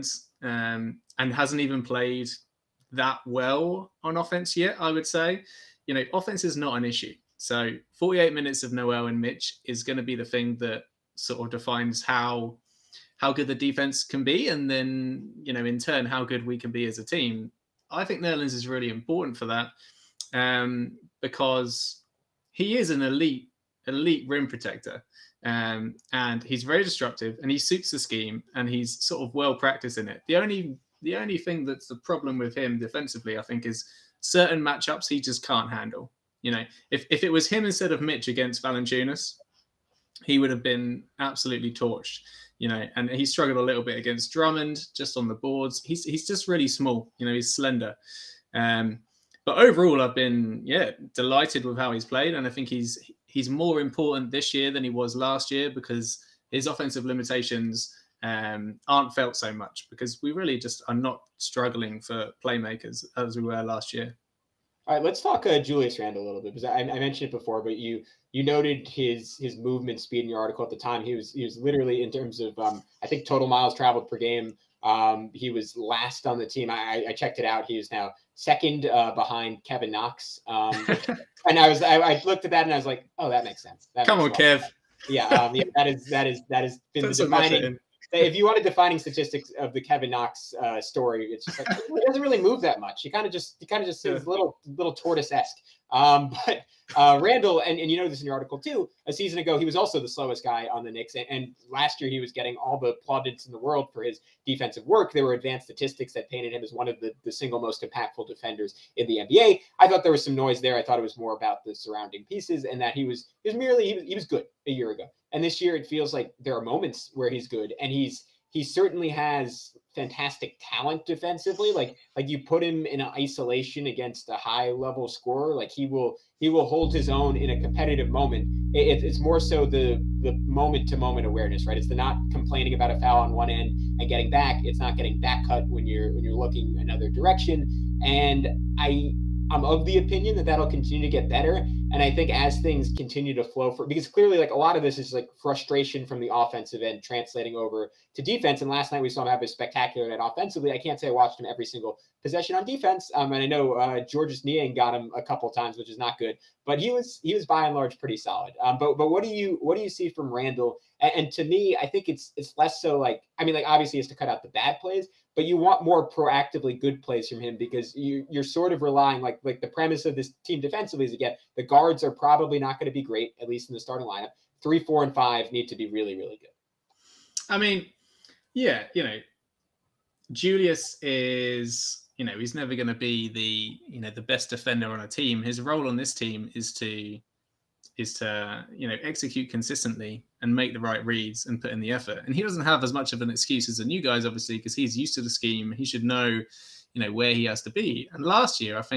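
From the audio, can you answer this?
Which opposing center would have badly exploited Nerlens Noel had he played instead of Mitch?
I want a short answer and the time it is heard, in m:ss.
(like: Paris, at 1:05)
Valanciunas, at 0:38.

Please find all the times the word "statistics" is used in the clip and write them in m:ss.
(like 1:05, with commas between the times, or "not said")
1:28, 1:45.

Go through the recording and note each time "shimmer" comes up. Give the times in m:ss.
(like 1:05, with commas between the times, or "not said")
not said.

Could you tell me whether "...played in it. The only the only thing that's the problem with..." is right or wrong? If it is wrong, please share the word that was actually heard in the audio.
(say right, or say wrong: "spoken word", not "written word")
wrong: "practiced", not "played".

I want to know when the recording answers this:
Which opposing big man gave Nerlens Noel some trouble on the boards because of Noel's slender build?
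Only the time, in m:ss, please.
0:44.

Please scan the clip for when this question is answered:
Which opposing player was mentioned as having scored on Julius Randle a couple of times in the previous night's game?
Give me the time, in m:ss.
2:34.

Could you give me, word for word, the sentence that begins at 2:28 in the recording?
And last night we saw him have a spectacular night offensively.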